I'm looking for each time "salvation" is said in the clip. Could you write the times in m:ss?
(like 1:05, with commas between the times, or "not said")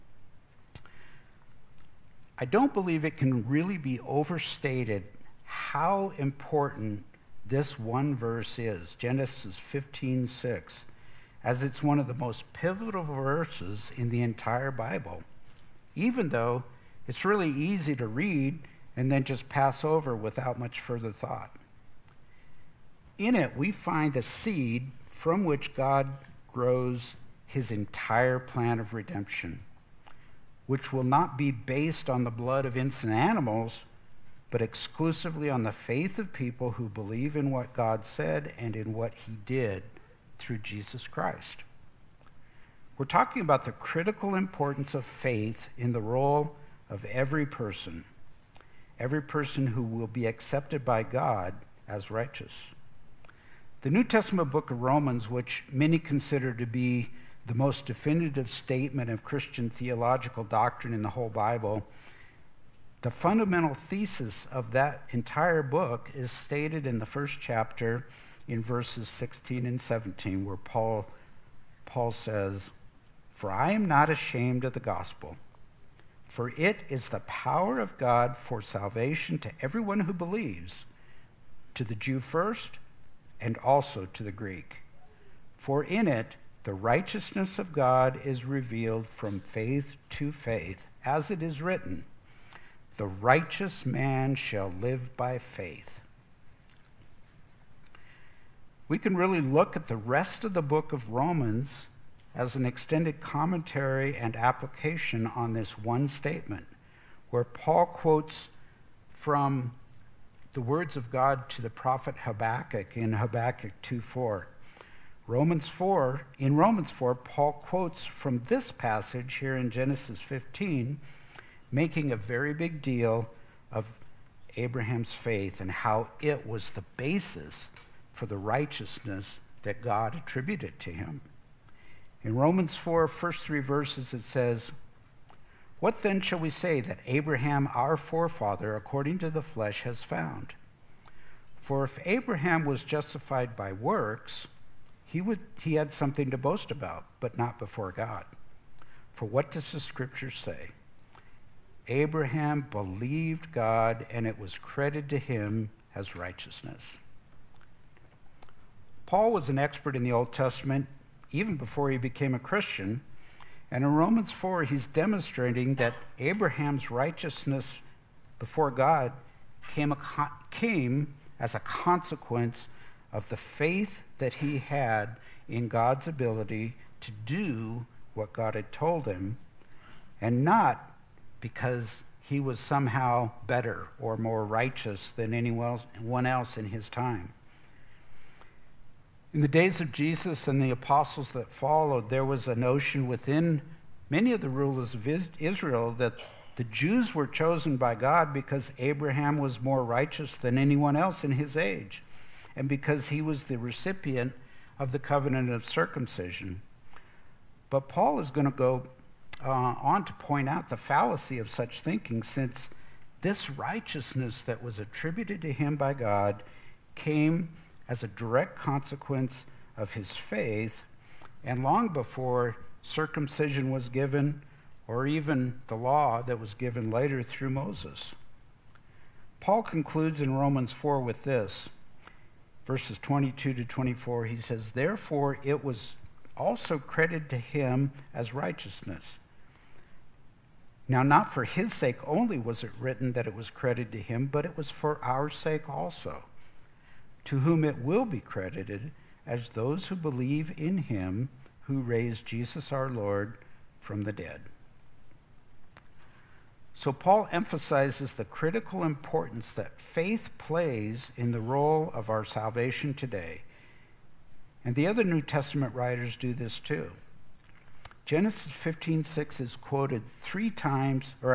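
1:18, 4:22.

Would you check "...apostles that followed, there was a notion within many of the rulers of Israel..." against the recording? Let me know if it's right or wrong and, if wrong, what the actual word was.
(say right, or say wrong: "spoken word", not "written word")
right.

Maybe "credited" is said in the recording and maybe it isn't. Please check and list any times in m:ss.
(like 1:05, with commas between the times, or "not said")
2:34, 3:56, 4:03, 4:08.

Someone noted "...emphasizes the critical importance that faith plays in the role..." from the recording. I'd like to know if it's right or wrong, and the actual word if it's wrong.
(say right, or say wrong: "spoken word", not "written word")
right.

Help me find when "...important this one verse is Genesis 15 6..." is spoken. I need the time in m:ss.
0:06.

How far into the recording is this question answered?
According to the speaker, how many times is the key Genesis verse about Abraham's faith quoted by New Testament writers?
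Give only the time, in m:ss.
4:30.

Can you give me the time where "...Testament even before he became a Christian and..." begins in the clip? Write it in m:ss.
2:40.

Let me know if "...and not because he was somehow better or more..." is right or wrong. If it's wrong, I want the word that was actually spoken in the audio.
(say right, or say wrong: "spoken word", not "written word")
right.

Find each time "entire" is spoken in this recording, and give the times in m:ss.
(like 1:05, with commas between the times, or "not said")
0:14, 0:27, 1:05.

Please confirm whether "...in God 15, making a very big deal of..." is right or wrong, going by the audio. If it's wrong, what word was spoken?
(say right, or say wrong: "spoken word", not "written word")
wrong: "Genesis", not "God".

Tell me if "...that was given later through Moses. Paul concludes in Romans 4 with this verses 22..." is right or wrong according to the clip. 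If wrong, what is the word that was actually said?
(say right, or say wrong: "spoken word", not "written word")
right.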